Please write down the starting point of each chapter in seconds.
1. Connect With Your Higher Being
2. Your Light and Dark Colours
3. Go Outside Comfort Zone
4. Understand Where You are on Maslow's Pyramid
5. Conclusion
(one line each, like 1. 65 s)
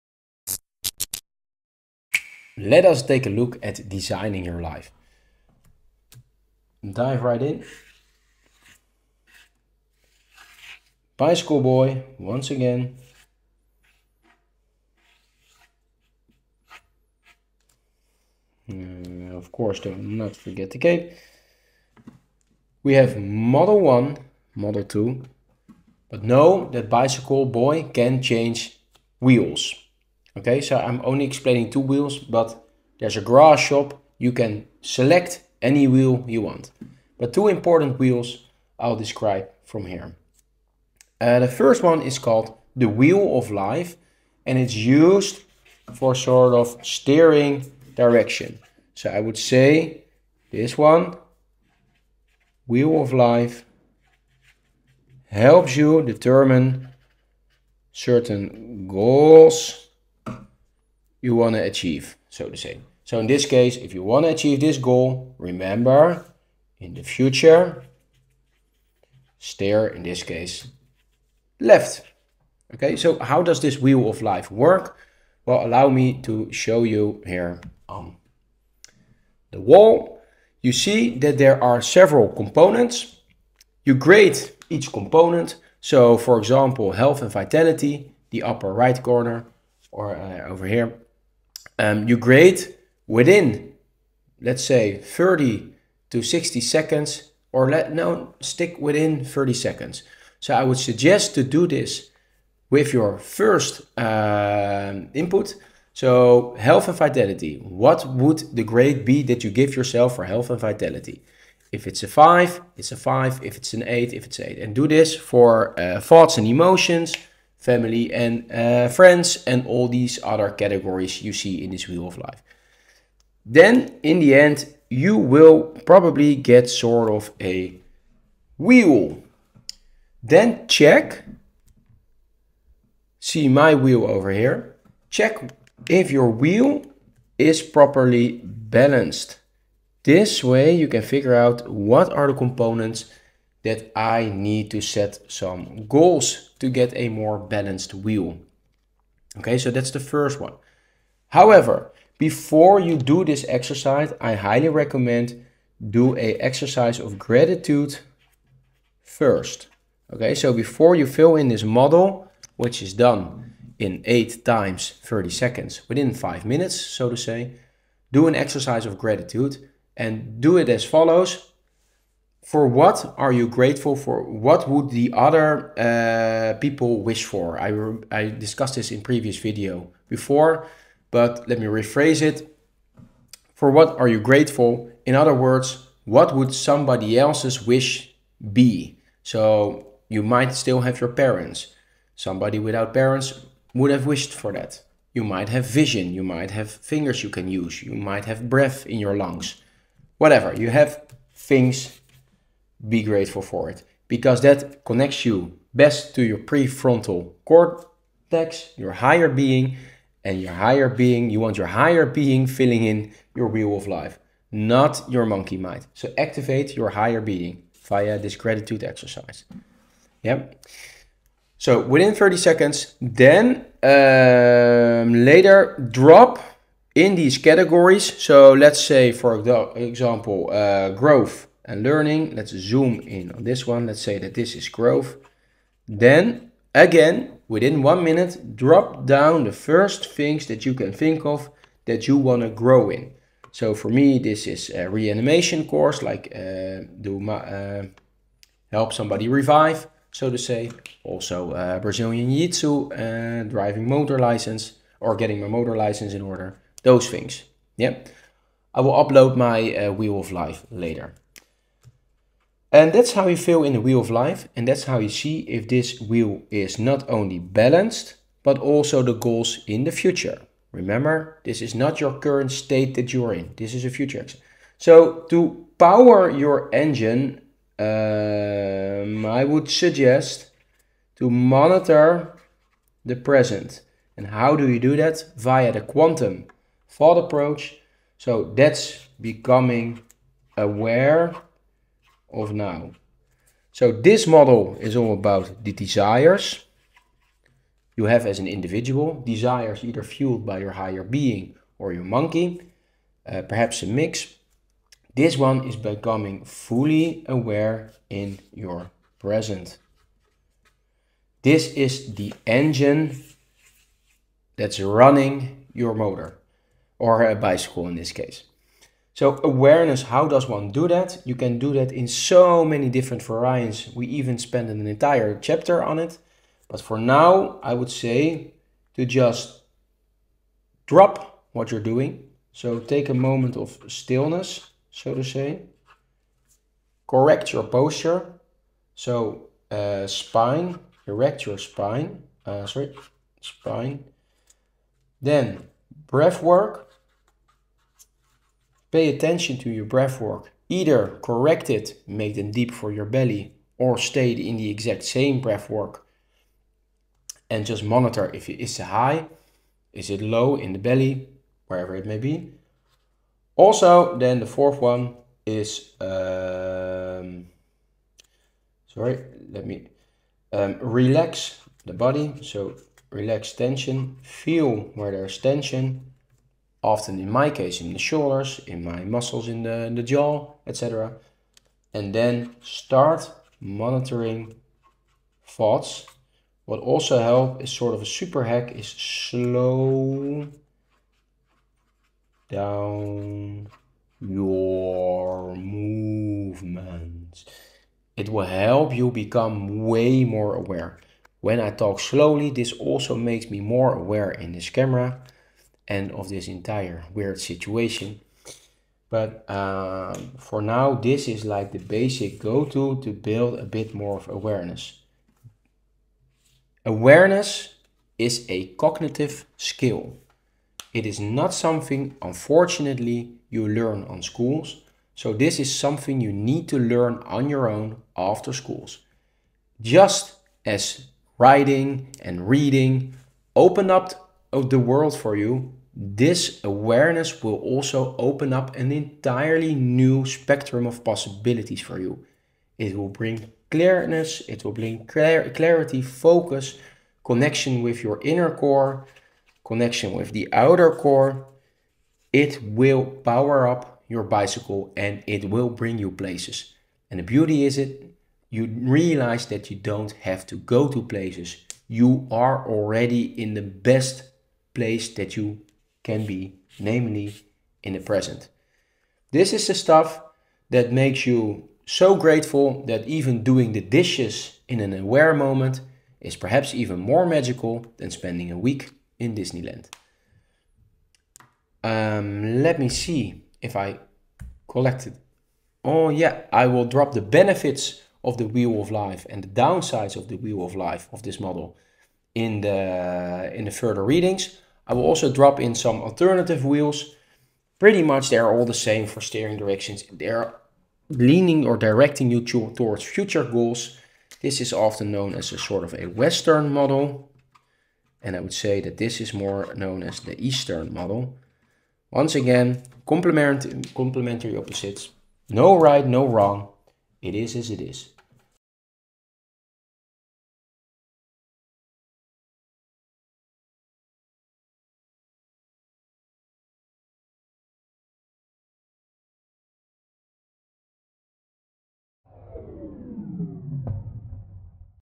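1. 43 s
2. 72 s
3. 143 s
4. 232 s
5. 287 s.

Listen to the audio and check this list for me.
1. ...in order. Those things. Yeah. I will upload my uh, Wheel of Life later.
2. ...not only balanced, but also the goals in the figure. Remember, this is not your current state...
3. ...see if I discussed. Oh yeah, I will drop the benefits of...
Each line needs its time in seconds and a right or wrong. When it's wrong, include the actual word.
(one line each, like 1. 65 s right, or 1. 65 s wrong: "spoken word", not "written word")
1. 256 s right
2. 266 s wrong: "future", not "figure"
3. 482 s wrong: "collected", not "discussed".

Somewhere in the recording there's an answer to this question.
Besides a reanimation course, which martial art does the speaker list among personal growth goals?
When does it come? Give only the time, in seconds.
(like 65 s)
251 s.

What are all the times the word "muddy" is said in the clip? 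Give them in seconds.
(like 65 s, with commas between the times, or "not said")
not said.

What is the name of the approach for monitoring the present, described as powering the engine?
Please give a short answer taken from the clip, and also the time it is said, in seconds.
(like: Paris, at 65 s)
quantum thought approach, at 285 s.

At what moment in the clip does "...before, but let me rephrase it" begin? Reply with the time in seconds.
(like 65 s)
180 s.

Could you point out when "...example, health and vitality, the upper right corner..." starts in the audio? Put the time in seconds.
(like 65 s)
86 s.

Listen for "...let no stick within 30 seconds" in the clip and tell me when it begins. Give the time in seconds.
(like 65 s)
97 s.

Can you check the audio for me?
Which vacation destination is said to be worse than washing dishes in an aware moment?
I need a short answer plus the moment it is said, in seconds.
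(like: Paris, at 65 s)
Disneyland, at 479 s.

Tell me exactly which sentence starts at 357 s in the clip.
And just monitor if it is high, is it low in the belly, wherever it may be.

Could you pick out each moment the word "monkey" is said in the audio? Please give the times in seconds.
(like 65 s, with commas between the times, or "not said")
215 s, 302 s.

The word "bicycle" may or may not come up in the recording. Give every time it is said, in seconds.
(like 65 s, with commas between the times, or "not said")
11 s, 26 s, 317 s, 454 s.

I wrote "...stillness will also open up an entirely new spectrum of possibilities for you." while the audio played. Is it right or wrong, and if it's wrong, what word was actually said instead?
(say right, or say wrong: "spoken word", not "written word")
wrong: "awareness", not "stillness".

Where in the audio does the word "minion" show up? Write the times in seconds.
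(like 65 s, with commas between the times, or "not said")
not said.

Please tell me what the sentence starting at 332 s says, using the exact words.
So take a moment of stillness, so to say.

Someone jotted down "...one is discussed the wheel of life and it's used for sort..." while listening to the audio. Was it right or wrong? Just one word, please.
wrong.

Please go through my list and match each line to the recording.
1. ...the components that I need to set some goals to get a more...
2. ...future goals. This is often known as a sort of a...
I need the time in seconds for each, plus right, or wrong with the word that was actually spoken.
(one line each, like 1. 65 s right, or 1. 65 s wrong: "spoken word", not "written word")
1. 142 s right
2. 503 s right.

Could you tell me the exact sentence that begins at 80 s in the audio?
You see that there are several components.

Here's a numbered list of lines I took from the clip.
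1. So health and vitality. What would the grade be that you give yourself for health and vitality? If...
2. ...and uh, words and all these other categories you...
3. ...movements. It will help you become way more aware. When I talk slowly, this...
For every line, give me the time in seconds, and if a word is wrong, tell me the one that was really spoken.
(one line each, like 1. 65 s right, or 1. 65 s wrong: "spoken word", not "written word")
1. 105 s right
2. 118 s wrong: "friends", not "words"
3. 395 s right.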